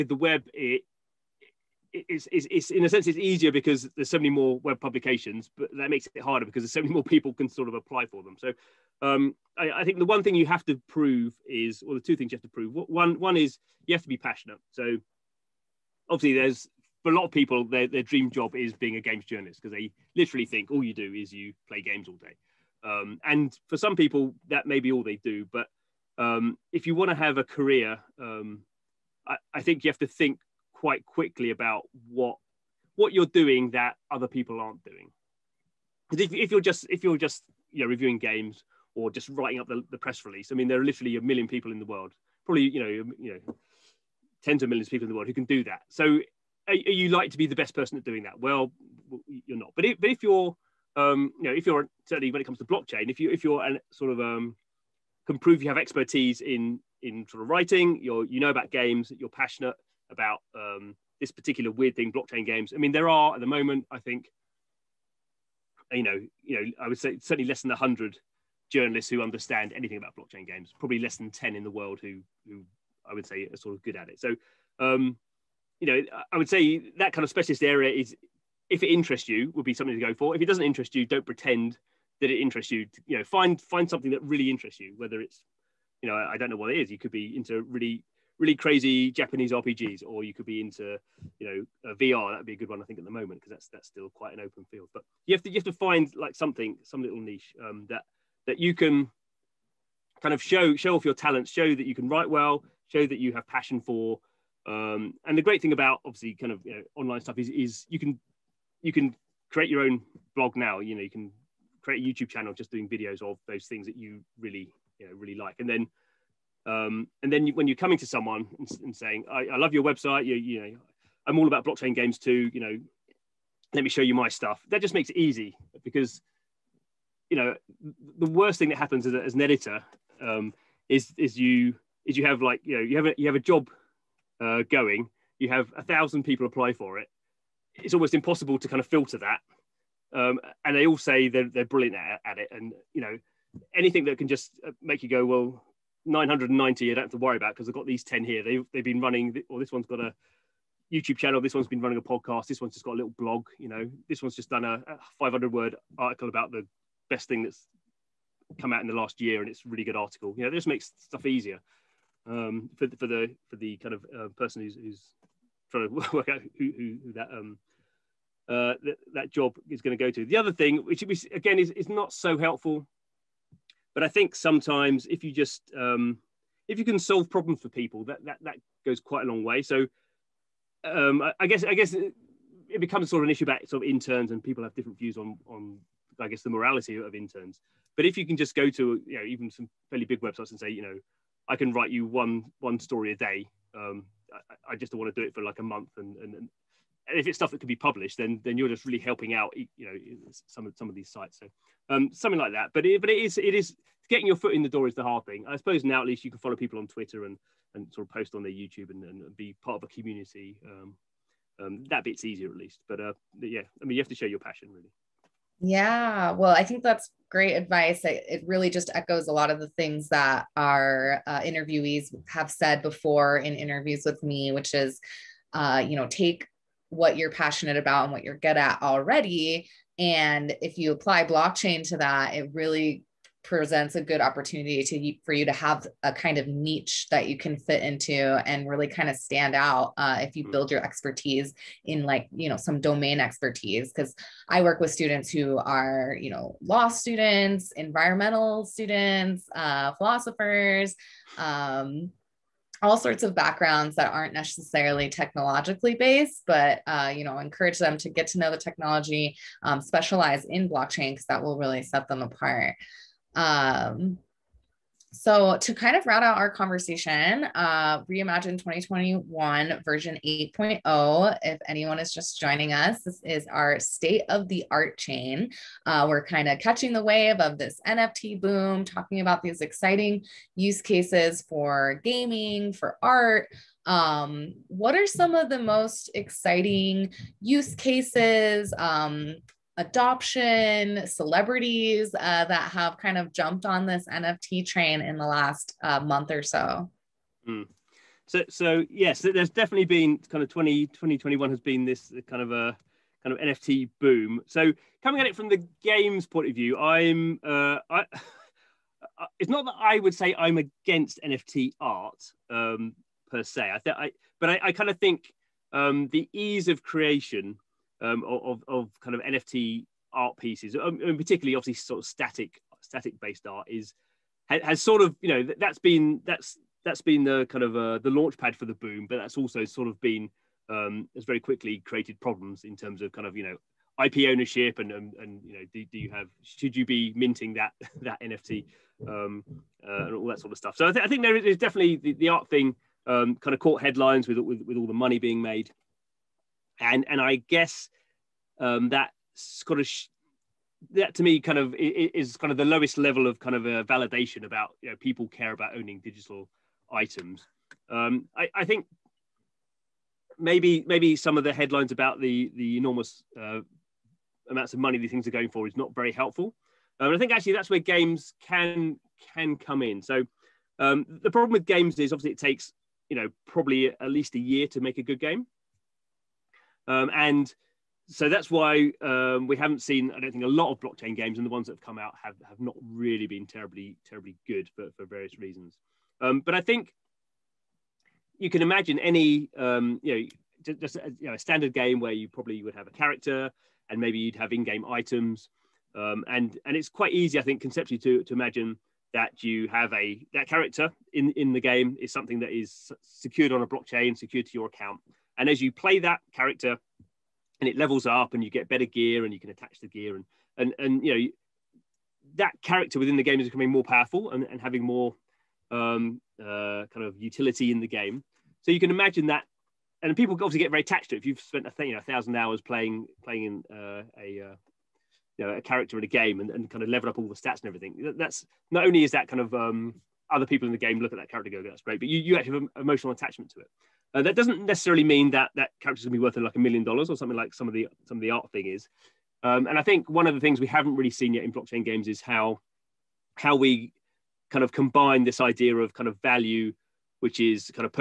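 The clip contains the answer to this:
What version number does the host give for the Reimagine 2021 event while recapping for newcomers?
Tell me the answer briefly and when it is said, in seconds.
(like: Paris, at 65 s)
8.0, at 269 s.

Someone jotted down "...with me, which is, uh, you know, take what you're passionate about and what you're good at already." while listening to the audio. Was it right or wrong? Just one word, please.
right.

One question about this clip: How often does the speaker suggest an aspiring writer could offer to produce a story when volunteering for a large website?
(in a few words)
one story a day.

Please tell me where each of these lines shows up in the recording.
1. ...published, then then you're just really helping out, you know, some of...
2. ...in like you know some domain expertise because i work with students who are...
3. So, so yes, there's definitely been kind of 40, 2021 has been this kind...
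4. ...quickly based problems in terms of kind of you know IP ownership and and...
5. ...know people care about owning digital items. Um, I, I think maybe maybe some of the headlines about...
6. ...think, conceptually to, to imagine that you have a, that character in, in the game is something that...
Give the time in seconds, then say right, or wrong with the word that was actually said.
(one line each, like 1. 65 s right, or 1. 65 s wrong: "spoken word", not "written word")
1. 197 s right
2. 241 s right
3. 298 s wrong: "20", not "40"
4. 331 s wrong: "created", not "based"
5. 354 s right
6. 397 s right.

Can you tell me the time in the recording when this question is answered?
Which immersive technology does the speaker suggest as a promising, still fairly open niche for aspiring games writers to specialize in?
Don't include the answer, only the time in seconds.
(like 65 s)
91 s.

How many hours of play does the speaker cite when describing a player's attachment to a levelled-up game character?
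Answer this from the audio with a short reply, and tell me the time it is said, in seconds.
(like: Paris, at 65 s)
1000, at 421 s.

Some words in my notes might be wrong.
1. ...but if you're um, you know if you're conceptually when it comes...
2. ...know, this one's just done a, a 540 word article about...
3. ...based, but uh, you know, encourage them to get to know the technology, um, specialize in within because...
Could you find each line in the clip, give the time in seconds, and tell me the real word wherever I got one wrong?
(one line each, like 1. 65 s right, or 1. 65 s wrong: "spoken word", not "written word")
1. 50 s wrong: "certainly", not "conceptually"
2. 153 s wrong: "500", not "540"
3. 255 s wrong: "blockchain", not "within".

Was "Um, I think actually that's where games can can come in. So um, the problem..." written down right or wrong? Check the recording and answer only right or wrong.
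right.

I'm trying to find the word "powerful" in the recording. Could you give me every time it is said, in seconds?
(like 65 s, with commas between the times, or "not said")
413 s.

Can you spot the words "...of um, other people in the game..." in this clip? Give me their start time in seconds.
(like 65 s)
429 s.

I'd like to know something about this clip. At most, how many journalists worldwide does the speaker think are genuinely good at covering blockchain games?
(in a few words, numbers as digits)
10.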